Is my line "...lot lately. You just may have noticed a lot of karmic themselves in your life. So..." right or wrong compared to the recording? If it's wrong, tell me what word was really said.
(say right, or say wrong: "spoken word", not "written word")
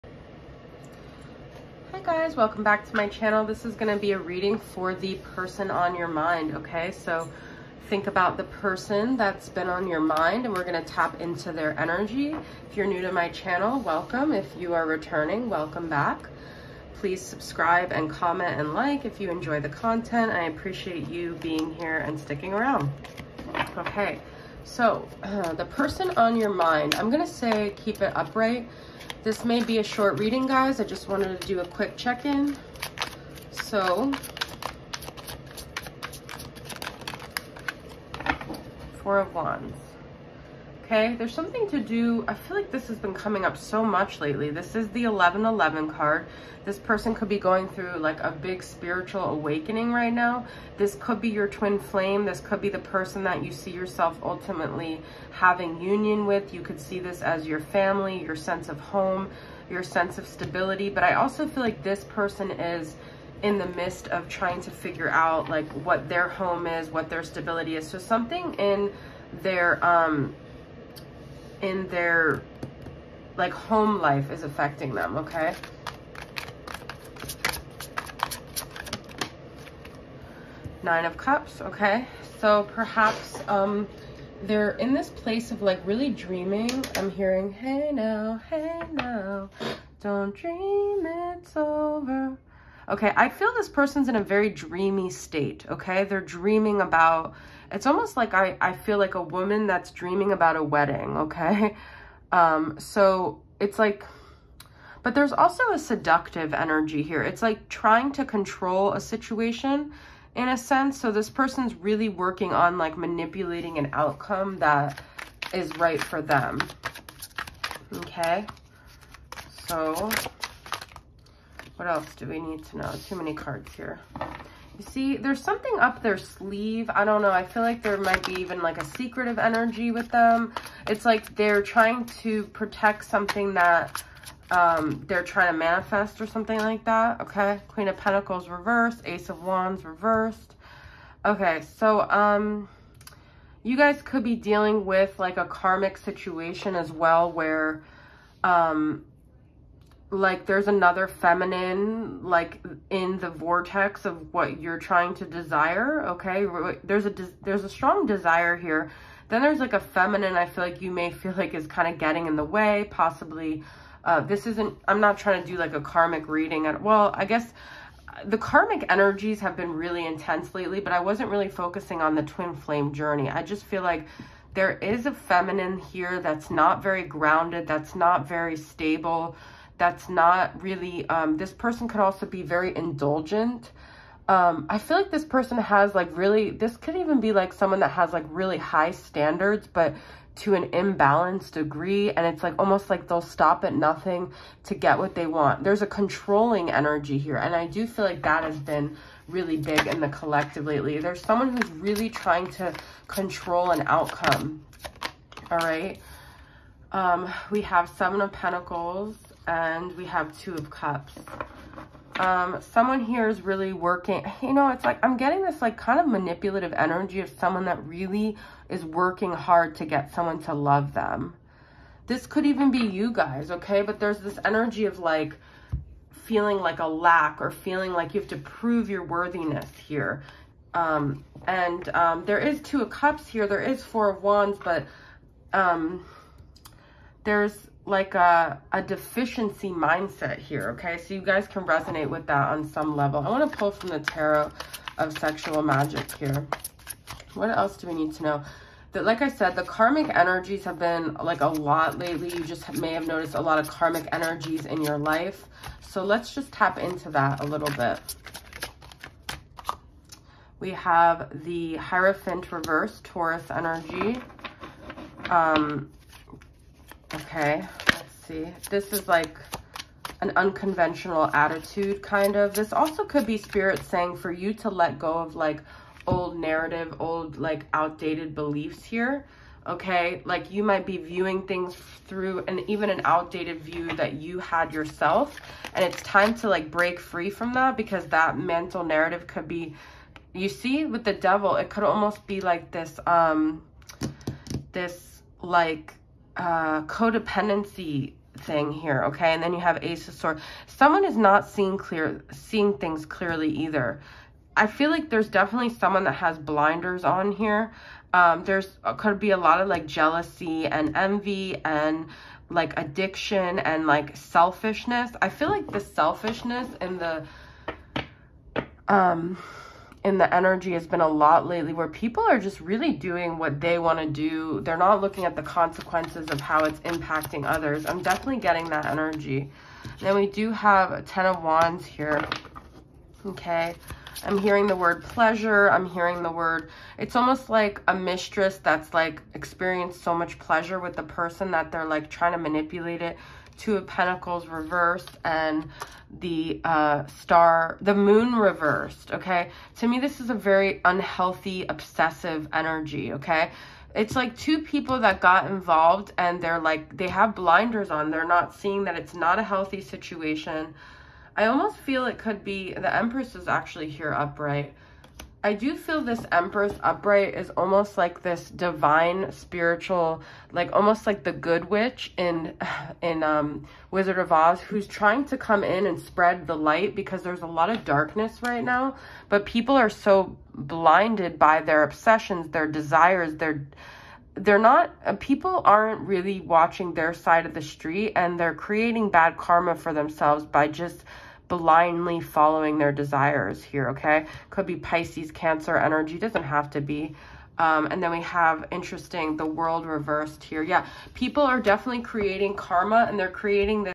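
wrong: "energies", not "themselves".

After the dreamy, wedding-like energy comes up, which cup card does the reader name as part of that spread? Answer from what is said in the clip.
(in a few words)
Nine of Cups.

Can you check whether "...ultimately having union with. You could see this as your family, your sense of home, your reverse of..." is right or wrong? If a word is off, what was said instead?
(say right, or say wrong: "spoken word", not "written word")
wrong: "sense", not "reverse".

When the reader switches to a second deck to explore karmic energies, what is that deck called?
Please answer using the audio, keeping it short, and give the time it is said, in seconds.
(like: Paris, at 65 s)
Tarot of sexual magic, at 243 s.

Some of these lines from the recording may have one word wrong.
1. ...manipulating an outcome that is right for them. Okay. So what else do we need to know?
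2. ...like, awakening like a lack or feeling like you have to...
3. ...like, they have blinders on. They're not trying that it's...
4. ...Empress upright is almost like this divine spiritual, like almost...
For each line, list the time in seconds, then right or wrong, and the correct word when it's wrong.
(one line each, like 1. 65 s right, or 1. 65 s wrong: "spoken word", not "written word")
1. 112 s right
2. 224 s wrong: "feeling", not "awakening"
3. 356 s wrong: "seeing", not "trying"
4. 366 s right.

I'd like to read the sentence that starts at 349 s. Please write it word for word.
To me, this is a very unhealthy, obsessive energy, okay?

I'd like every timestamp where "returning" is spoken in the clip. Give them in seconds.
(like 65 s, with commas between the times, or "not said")
14 s.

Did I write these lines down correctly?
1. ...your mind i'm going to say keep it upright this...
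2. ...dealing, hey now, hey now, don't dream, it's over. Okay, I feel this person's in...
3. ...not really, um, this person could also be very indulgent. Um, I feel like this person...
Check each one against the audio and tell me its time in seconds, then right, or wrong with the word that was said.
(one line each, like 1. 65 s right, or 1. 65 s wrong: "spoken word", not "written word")
1. 26 s right
2. 87 s wrong: "hearing", not "dealing"
3. 180 s right.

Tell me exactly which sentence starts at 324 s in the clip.
They're not looking at the consequences of how it's impacting others.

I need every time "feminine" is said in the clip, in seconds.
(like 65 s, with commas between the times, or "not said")
151 s, 159 s, 175 s.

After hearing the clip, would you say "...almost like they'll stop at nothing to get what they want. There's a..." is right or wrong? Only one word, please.
right.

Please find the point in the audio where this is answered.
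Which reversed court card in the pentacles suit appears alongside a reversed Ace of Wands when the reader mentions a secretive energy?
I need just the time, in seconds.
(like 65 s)
137 s.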